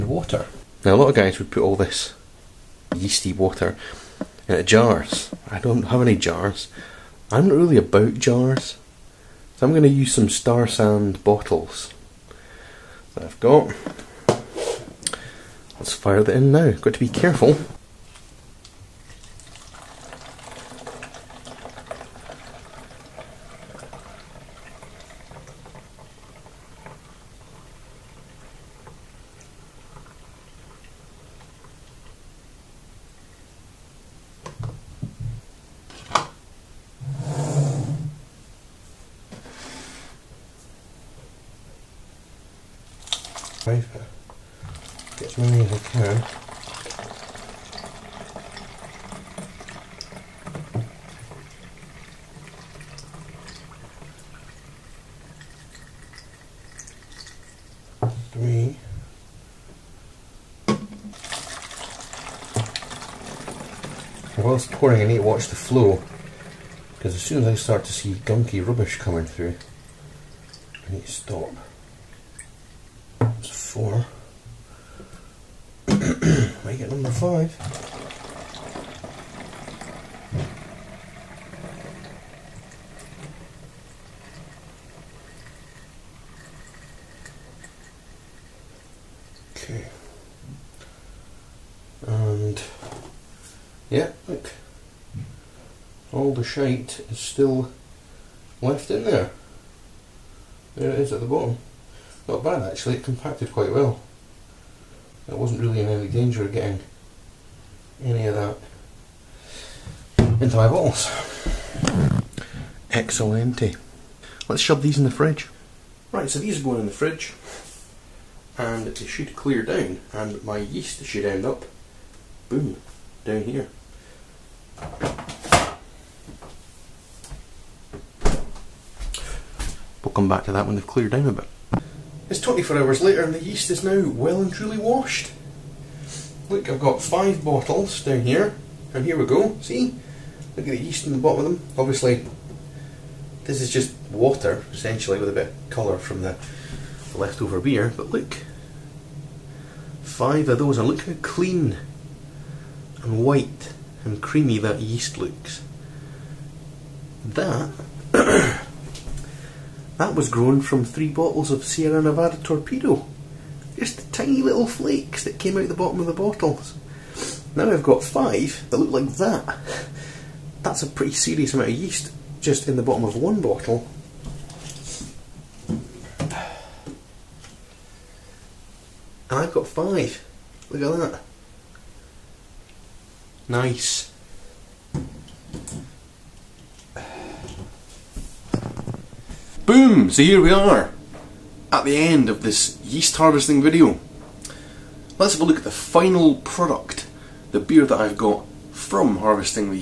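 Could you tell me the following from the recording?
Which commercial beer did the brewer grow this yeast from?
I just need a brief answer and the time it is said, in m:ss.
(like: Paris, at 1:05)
Sierra Nevada Torpedo, at 2:41.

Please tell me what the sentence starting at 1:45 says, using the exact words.
I wasn't really in any danger of getting any of that into my bottles.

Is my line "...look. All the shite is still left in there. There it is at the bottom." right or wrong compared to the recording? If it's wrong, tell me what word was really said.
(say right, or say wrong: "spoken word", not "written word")
right.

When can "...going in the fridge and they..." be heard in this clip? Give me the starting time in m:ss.
1:56.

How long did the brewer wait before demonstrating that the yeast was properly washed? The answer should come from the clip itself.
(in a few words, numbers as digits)
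24 hours.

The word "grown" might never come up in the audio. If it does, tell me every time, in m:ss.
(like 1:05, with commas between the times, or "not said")
2:40.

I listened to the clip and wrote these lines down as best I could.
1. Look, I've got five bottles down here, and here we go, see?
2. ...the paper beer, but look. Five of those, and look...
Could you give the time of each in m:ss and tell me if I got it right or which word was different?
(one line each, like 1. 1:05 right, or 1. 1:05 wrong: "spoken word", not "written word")
1. 2:16 right
2. 2:26 wrong: "leftover", not "paper".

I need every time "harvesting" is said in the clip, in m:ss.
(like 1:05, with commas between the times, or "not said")
3:13, 3:19.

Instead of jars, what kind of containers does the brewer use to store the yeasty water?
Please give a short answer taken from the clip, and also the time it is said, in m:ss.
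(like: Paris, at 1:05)
Star San bottles, at 0:10.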